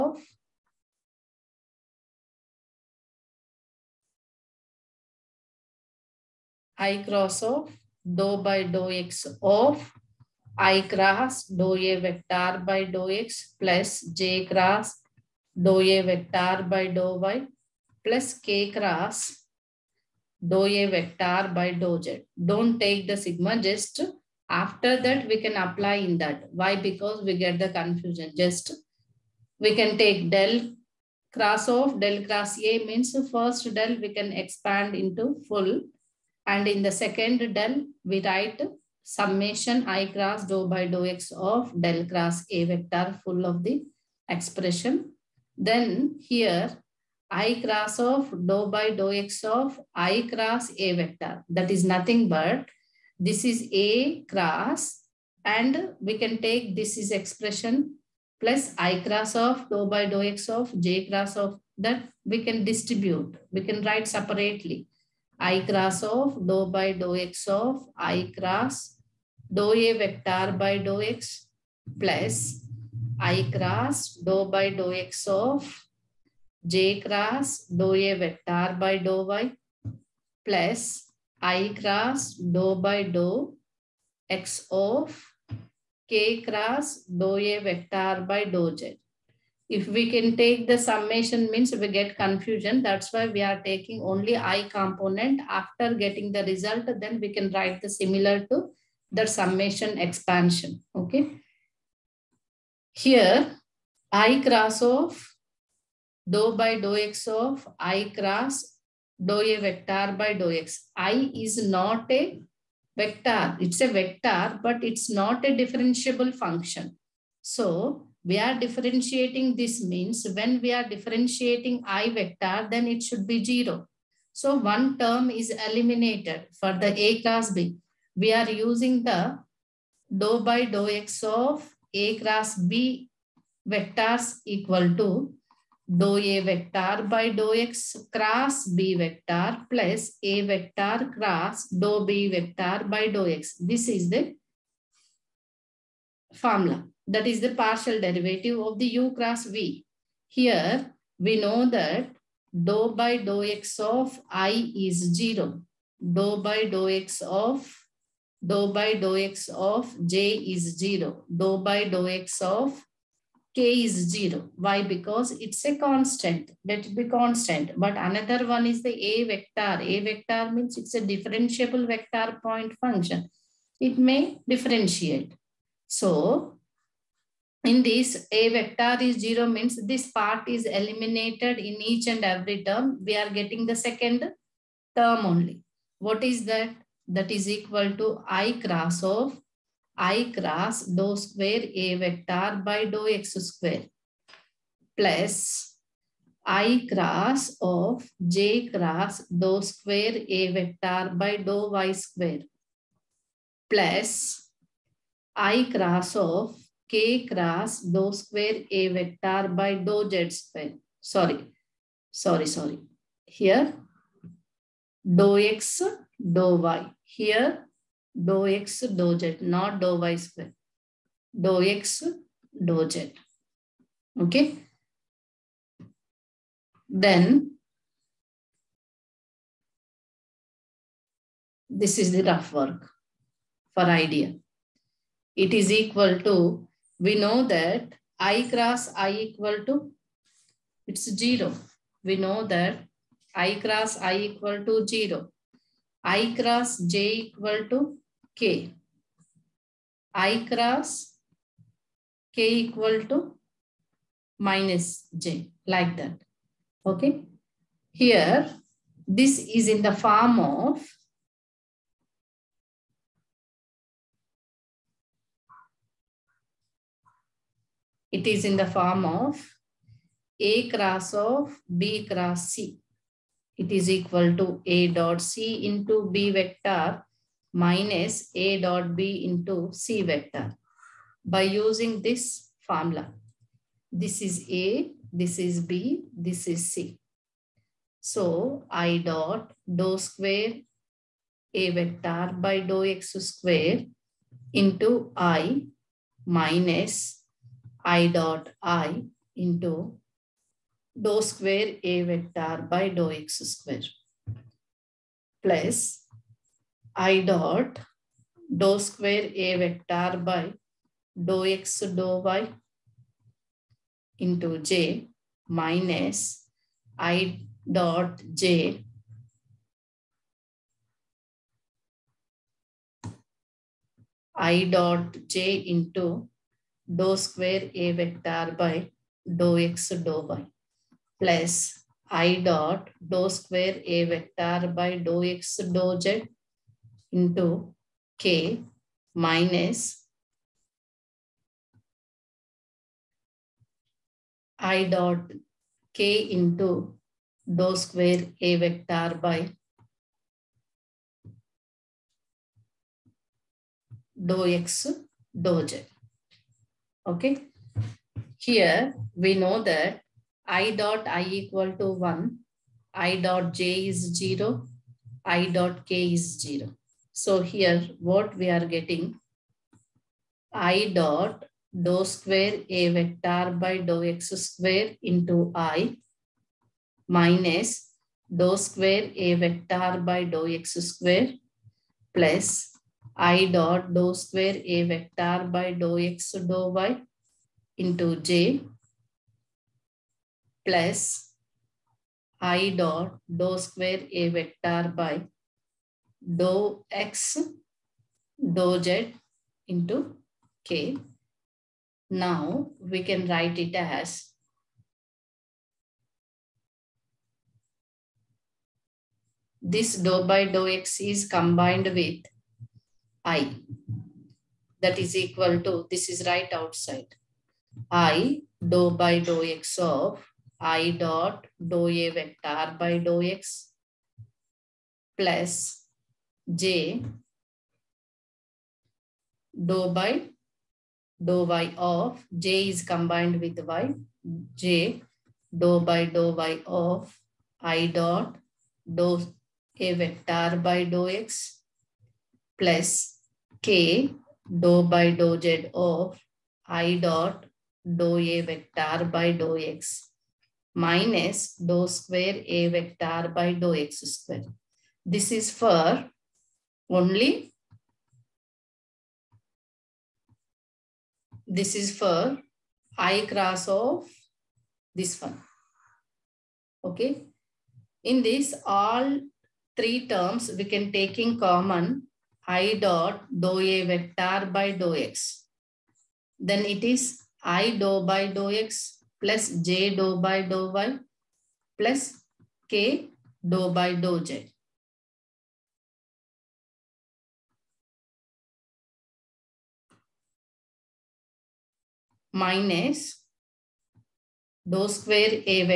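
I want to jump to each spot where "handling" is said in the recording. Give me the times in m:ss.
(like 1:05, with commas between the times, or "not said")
not said.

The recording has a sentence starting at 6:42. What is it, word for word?
Now we can write it as this dou by dou x is combined with I.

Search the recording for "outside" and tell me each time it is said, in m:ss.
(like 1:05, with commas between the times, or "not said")
6:56.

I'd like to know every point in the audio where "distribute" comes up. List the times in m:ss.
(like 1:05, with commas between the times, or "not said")
1:02.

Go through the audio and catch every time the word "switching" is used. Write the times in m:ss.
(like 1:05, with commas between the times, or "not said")
not said.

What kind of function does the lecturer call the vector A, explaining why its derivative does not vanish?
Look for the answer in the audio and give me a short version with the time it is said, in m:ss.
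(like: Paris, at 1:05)
differentiable vector point function, at 2:51.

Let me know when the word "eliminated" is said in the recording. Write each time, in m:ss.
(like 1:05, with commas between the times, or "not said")
2:05, 3:00.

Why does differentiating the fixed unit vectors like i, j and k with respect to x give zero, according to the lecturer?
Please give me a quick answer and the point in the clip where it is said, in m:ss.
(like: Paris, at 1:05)
It's a constant, at 2:45.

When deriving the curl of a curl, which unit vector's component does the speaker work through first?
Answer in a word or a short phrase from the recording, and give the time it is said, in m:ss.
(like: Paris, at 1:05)
i component, at 1:34.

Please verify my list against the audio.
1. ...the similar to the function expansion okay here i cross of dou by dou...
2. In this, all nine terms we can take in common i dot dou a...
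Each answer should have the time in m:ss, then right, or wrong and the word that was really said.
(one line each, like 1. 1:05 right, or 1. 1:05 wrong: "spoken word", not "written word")
1. 1:37 wrong: "summation", not "function"
2. 7:48 wrong: "three", not "nine".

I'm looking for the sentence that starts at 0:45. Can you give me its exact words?
Then here, i cross of dou by dou x of i cross a vector.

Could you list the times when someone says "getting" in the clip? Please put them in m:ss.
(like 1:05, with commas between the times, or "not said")
1:35, 3:03, 6:08.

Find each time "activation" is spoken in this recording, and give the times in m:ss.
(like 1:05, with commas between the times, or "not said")
not said.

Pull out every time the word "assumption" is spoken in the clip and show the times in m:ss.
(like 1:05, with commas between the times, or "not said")
not said.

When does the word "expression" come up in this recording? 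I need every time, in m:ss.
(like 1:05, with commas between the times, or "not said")
0:44, 0:57.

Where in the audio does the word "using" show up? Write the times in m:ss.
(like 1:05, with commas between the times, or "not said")
2:08, 4:41.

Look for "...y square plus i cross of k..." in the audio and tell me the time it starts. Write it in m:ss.
3:21.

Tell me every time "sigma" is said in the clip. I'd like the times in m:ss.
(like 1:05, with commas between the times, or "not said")
0:23.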